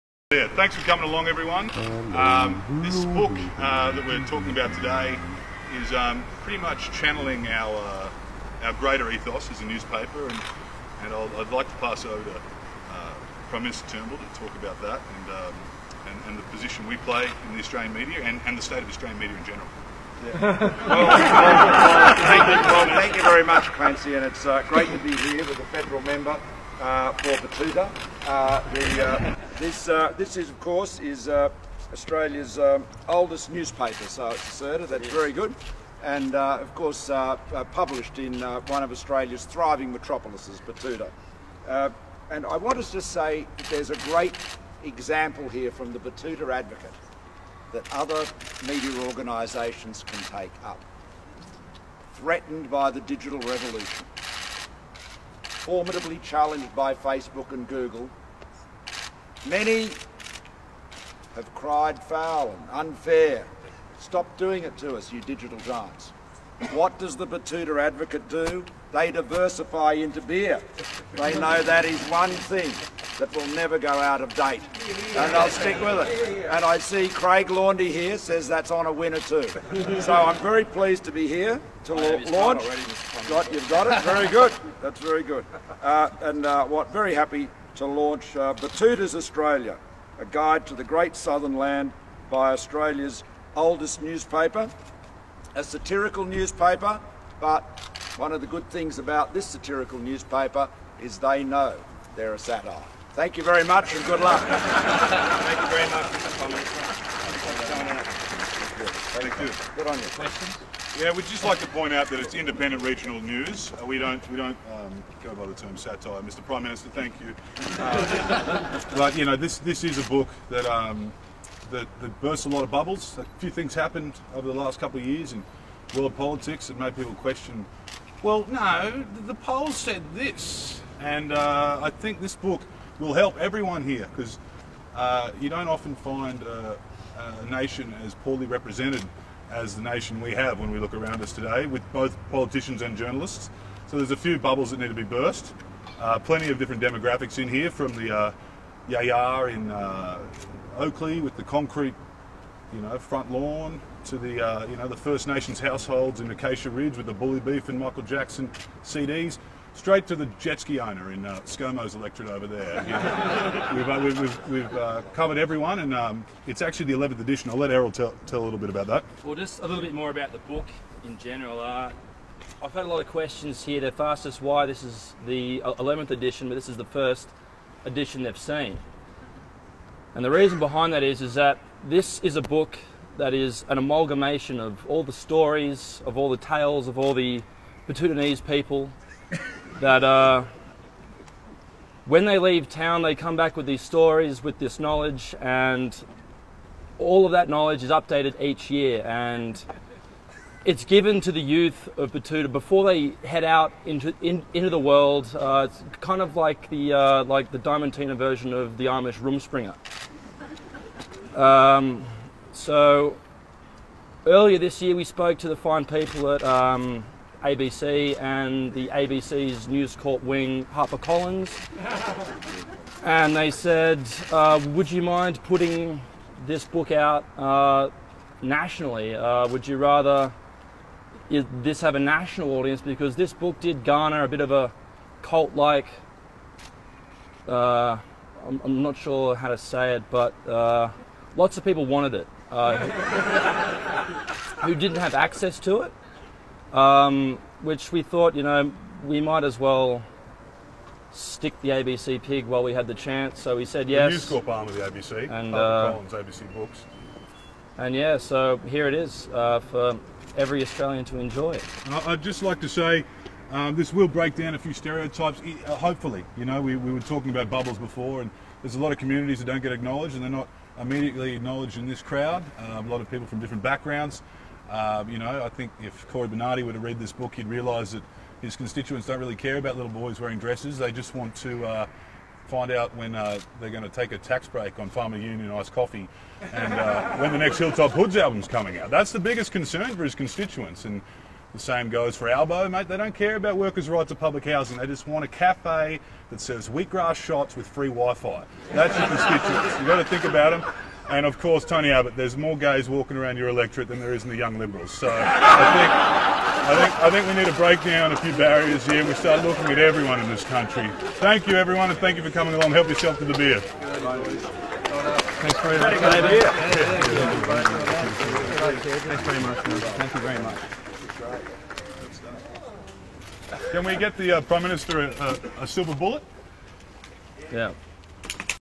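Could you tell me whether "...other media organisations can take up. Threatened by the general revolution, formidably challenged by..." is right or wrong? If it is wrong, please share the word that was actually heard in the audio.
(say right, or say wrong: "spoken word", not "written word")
wrong: "digital", not "general".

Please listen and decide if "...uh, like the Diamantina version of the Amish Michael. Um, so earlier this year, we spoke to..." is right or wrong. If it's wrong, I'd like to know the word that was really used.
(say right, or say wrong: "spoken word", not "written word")
wrong: "Rumspringa", not "Michael".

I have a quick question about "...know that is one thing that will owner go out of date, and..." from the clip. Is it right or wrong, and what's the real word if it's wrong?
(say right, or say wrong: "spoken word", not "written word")
wrong: "never", not "owner".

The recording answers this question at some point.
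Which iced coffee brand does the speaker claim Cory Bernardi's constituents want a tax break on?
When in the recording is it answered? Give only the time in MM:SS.
04:44.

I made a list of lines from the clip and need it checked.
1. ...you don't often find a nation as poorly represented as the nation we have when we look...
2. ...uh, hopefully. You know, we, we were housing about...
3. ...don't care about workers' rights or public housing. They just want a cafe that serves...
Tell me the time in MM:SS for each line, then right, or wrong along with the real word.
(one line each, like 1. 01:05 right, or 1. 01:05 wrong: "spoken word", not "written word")
1. 02:15 right
2. 04:25 wrong: "talking", not "housing"
3. 04:52 right.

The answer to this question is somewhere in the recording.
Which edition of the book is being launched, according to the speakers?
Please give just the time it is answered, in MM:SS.
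02:46.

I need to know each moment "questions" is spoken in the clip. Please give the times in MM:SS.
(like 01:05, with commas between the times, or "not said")
01:50, 02:07, 02:53.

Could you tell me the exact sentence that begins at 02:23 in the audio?
So there's a few bubbles that need to be burst.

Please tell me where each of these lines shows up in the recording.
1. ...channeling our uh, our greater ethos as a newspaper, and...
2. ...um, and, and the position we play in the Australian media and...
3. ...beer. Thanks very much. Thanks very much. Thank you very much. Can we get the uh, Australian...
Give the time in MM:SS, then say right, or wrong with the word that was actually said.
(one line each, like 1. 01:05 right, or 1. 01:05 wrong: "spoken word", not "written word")
1. 00:06 right
2. 00:15 right
3. 05:13 wrong: "Prime", not "Australian".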